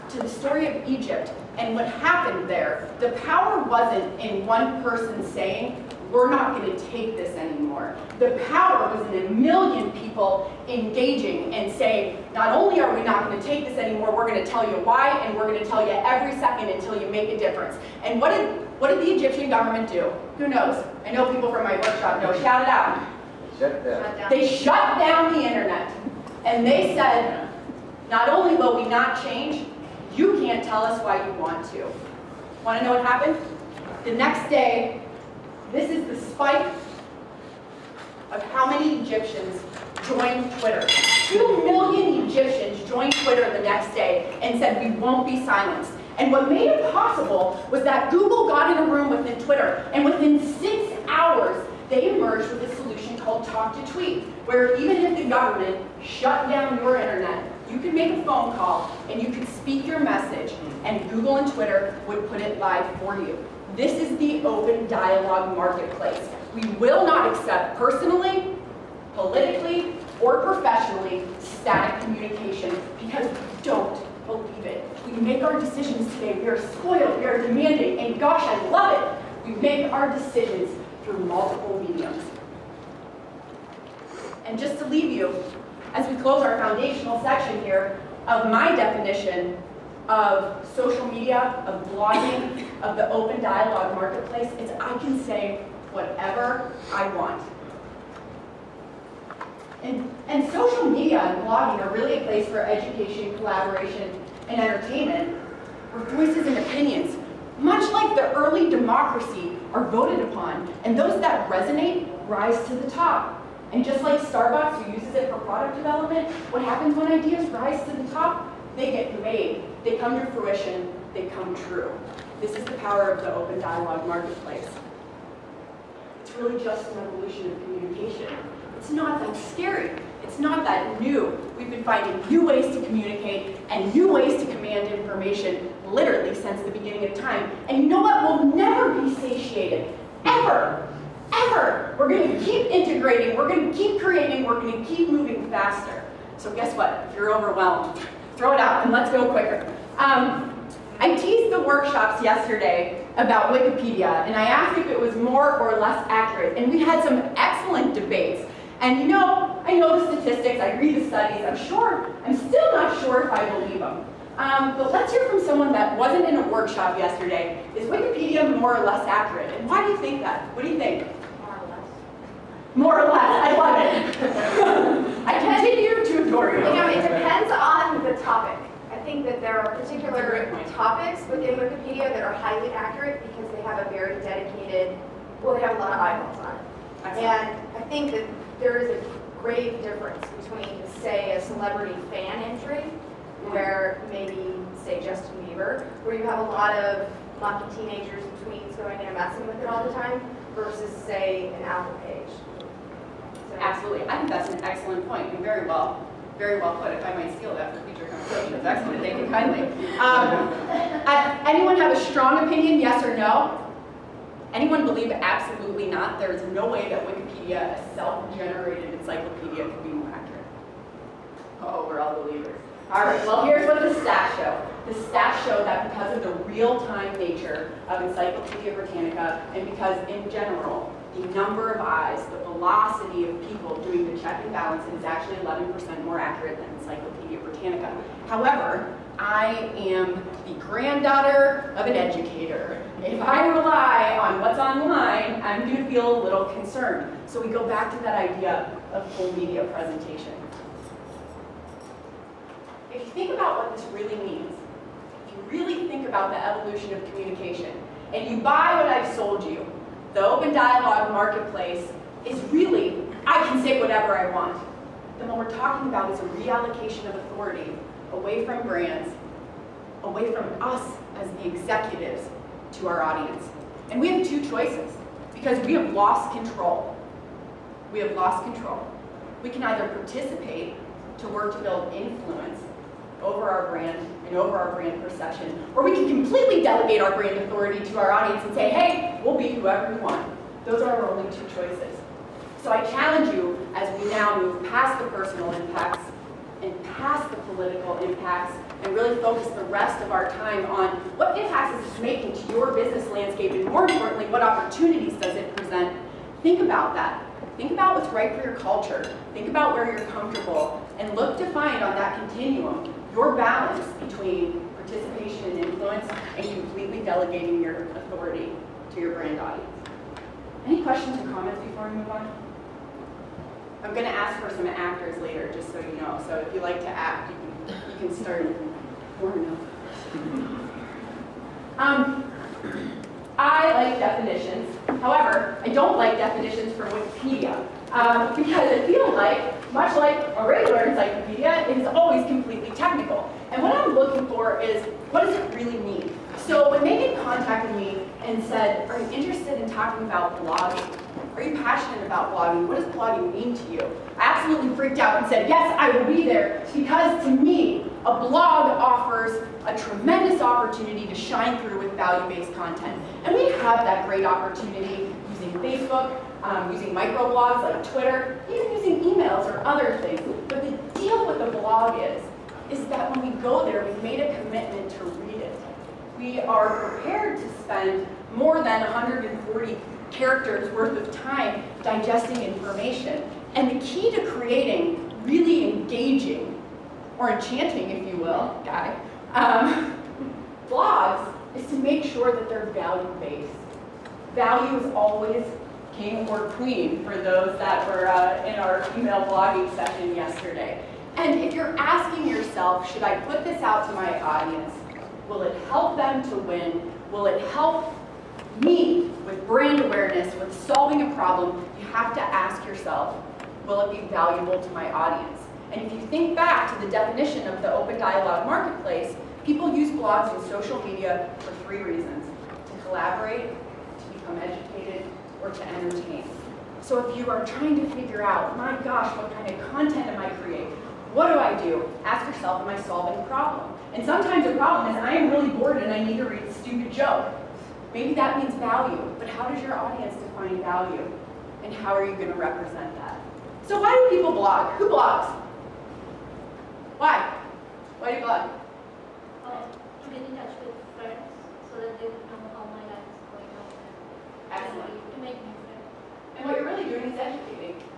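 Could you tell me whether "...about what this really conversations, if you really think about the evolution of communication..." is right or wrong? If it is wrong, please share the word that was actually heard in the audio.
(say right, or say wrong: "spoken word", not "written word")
wrong: "means", not "conversations".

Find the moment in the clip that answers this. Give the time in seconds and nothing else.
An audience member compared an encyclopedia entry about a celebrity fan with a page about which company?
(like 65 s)
201 s.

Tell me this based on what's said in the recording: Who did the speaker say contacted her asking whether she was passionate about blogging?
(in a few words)
Megan.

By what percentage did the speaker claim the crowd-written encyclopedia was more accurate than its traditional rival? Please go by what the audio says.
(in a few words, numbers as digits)
11%.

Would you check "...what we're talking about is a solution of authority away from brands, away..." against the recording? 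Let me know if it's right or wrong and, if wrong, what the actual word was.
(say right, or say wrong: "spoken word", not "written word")
wrong: "reallocation", not "solution".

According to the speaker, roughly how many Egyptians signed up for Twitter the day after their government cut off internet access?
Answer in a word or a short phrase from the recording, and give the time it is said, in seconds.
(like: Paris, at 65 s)
2 million, at 41 s.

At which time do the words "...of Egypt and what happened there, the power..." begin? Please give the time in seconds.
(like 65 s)
0 s.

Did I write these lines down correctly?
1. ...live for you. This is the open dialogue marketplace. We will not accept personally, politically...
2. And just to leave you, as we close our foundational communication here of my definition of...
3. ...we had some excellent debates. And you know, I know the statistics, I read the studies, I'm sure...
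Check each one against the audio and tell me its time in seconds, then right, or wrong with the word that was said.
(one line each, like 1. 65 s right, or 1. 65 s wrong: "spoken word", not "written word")
1. 62 s right
2. 84 s wrong: "section", not "communication"
3. 156 s right.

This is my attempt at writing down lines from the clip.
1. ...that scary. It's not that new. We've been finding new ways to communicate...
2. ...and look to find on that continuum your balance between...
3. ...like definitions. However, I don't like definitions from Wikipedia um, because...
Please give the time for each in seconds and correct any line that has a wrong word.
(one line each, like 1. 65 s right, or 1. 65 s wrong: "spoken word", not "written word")
1. 129 s right
2. 310 s right
3. 333 s right.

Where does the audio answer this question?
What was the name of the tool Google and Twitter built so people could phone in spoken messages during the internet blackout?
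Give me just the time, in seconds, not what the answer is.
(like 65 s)
53 s.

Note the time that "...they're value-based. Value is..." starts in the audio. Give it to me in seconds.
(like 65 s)
392 s.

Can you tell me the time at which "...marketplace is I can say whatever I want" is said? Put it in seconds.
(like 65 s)
93 s.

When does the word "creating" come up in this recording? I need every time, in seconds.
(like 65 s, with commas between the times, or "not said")
144 s, 384 s, 430 s.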